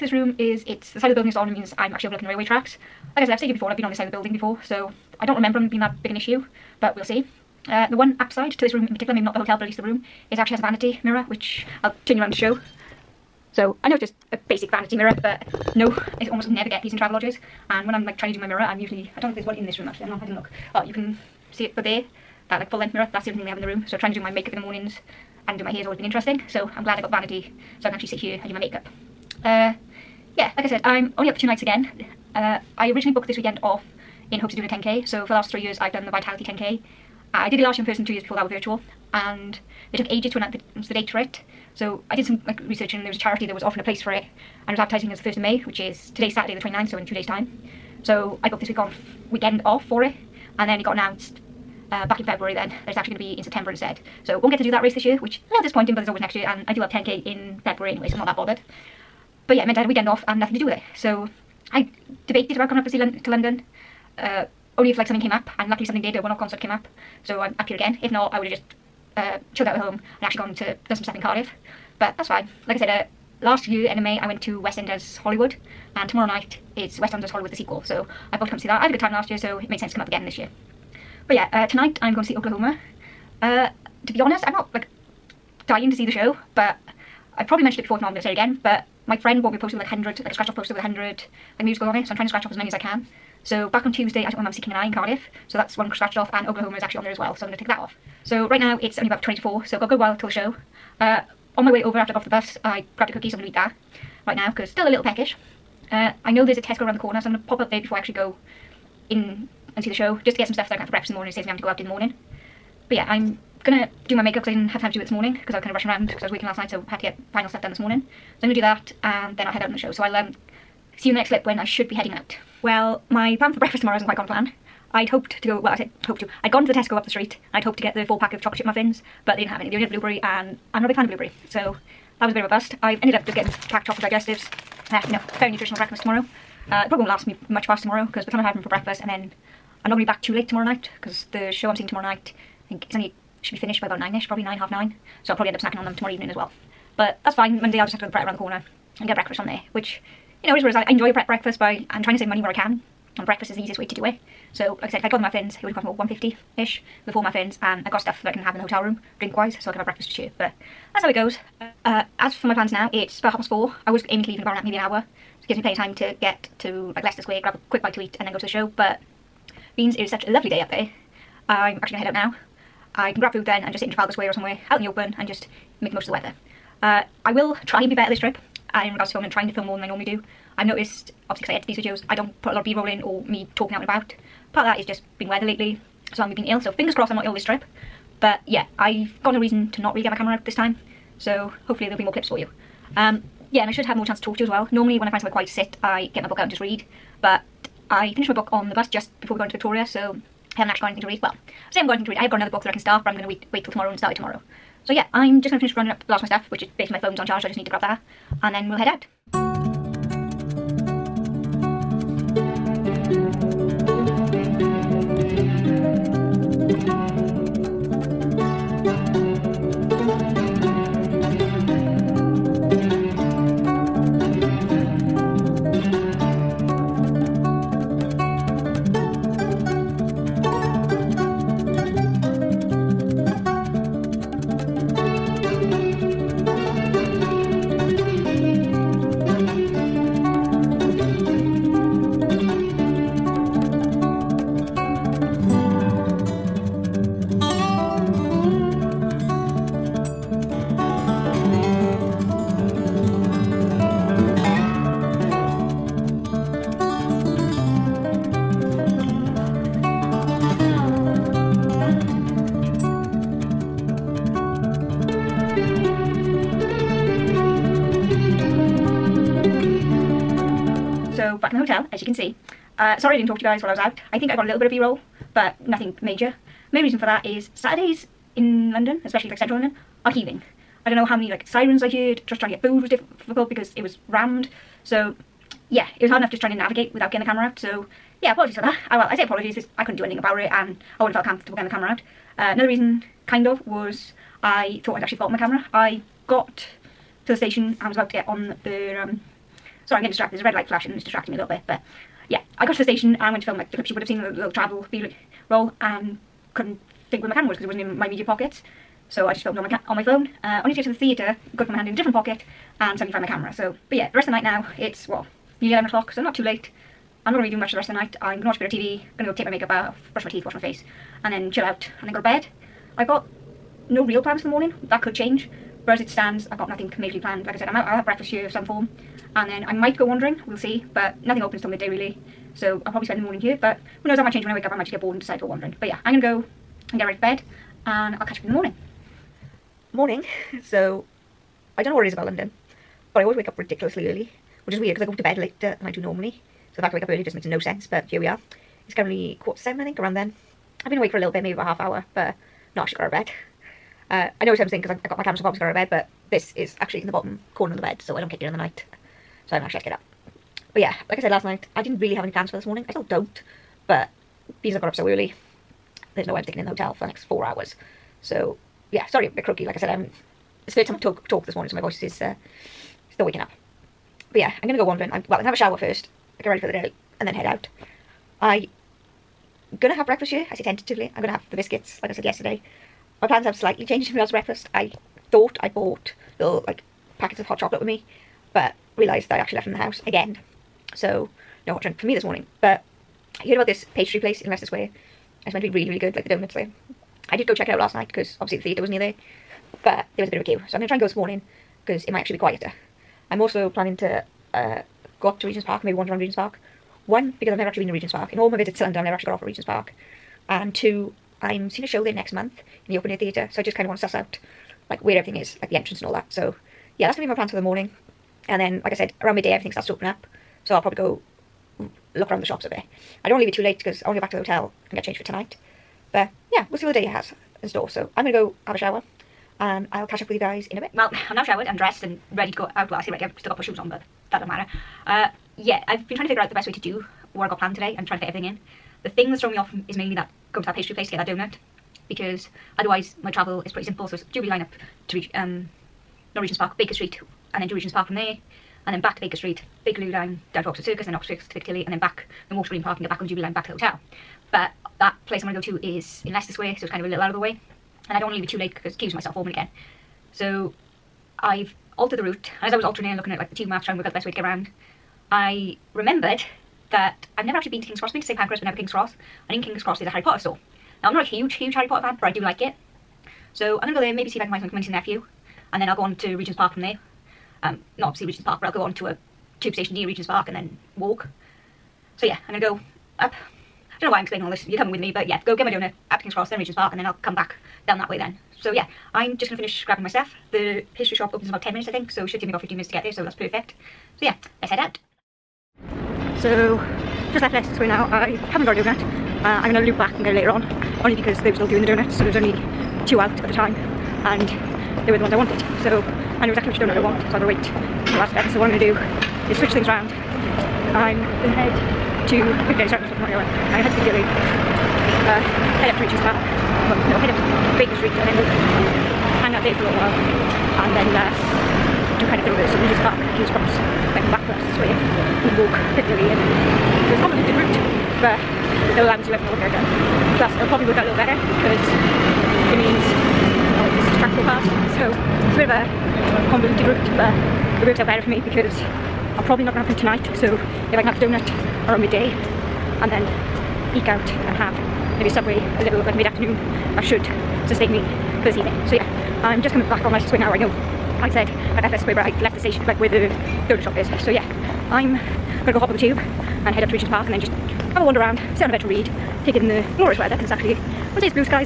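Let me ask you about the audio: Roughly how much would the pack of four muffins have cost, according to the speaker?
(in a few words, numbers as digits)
150-ish.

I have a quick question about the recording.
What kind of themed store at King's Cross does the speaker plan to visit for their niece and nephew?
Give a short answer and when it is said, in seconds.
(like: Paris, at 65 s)
Harry Potter store, at 470 s.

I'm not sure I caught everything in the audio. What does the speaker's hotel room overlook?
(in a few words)
The railway tracks.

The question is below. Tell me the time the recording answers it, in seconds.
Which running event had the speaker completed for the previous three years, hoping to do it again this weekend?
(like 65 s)
36 s.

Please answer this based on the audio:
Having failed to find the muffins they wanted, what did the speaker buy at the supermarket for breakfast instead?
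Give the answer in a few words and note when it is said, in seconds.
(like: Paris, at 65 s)
Chocolate digestives, at 133 s.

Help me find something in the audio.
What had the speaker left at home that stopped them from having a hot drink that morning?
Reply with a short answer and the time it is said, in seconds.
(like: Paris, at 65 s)
Packets of hot chocolate, at 387 s.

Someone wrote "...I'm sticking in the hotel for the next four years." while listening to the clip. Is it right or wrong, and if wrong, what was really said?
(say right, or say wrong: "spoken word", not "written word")
wrong: "hours", not "years".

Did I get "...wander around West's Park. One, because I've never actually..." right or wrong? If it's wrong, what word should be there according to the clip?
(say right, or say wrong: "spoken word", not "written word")
wrong: "Regent", not "West".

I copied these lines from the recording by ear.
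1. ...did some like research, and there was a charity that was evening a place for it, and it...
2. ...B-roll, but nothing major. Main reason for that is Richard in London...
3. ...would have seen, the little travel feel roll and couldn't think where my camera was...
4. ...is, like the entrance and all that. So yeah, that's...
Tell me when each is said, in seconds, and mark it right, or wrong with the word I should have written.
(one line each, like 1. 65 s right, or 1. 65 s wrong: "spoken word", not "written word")
1. 42 s wrong: "offering", not "evening"
2. 274 s wrong: "Saturdays", not "Richard"
3. 303 s right
4. 415 s right.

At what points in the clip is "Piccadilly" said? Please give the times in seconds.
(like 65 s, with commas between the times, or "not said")
451 s, 525 s.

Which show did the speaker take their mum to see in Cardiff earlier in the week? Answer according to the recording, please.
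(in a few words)
King and I.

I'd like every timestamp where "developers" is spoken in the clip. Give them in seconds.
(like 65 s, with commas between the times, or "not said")
not said.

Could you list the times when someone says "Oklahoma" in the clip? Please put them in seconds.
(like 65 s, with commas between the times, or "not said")
82 s, 96 s.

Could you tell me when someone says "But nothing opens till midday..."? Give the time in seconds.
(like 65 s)
330 s.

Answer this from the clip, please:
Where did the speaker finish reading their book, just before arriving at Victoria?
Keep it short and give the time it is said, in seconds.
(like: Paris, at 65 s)
On the bus, at 198 s.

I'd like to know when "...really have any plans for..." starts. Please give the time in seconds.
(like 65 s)
361 s.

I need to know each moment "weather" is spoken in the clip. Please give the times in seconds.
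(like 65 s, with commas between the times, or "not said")
176 s, 185 s, 560 s.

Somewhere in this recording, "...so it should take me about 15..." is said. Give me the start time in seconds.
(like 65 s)
492 s.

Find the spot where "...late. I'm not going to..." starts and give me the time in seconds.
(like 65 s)
316 s.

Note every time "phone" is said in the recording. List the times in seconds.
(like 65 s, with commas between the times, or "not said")
206 s, 310 s.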